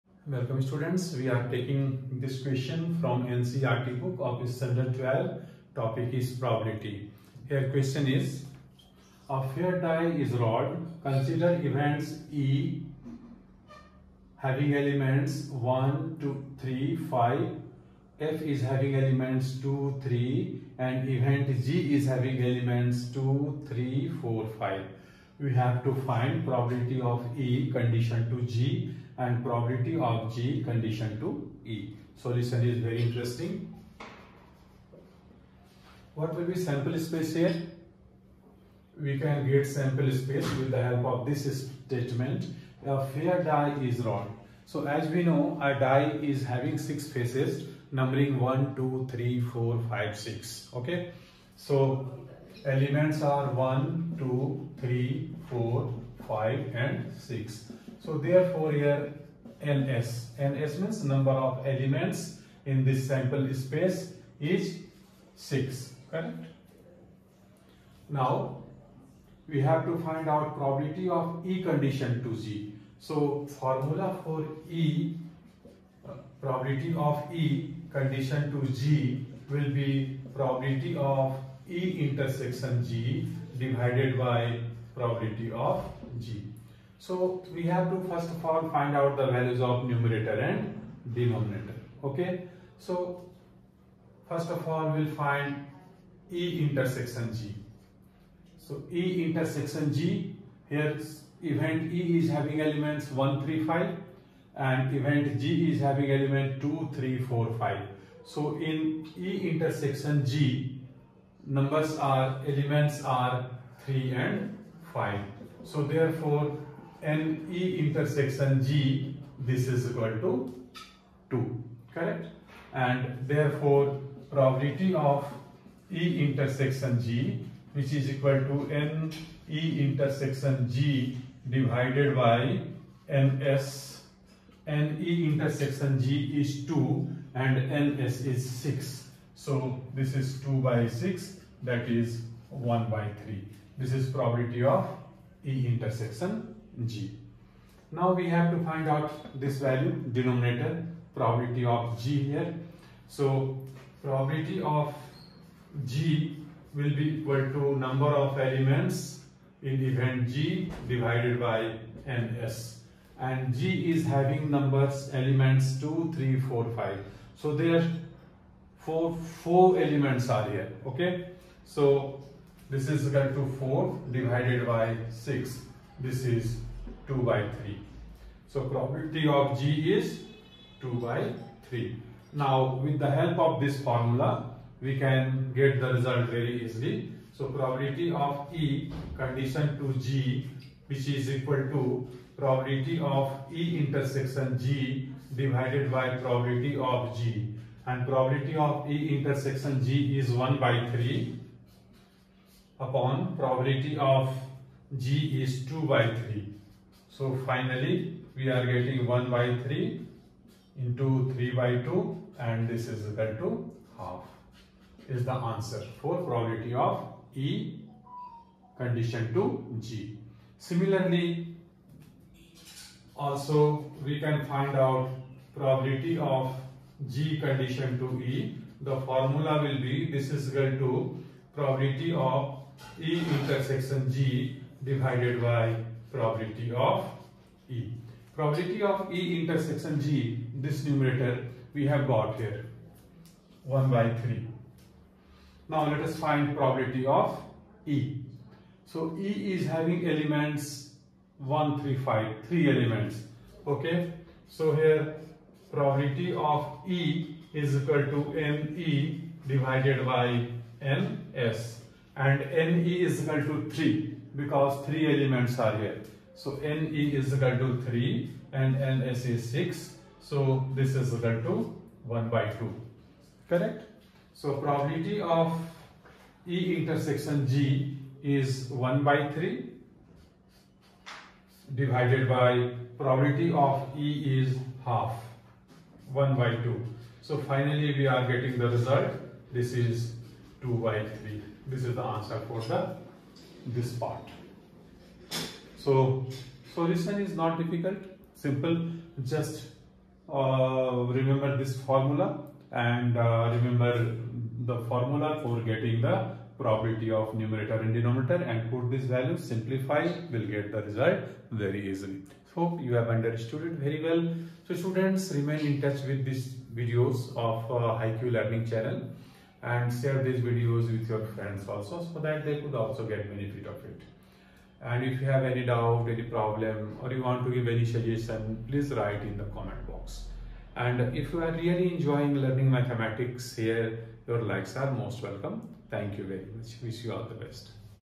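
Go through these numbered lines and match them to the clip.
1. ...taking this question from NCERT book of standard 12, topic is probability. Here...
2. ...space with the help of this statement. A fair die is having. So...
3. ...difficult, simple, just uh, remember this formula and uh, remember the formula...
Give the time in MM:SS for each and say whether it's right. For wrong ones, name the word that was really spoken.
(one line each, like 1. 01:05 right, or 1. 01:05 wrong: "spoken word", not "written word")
1. 00:01 right
2. 00:40 wrong: "wrong", not "having"
3. 04:57 right.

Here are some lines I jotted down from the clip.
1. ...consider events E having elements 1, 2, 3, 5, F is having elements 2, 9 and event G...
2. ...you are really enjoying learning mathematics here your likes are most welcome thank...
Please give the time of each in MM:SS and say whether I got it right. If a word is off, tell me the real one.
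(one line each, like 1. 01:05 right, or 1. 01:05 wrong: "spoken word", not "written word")
1. 00:11 wrong: "3", not "9"
2. 05:31 right.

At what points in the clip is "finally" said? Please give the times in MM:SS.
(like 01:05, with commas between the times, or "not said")
03:27, 04:47.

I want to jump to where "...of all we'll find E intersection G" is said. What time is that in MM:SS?
01:34.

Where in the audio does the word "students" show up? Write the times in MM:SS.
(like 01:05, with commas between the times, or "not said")
00:00, 05:14.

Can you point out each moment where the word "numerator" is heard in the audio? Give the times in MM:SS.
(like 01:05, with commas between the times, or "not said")
01:29, 04:00, 05:07.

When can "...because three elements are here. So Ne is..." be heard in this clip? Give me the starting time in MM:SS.
04:24.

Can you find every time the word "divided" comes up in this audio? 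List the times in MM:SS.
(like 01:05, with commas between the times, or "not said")
01:23, 02:11, 02:40, 02:54, 03:15, 03:54, 04:19, 04:41.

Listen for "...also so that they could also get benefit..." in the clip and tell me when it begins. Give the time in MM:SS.
05:21.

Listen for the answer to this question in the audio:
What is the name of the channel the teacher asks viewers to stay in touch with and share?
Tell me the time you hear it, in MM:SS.
05:17.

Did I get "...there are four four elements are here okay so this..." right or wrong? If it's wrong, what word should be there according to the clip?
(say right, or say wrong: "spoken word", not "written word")
right.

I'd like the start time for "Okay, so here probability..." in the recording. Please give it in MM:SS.
04:13.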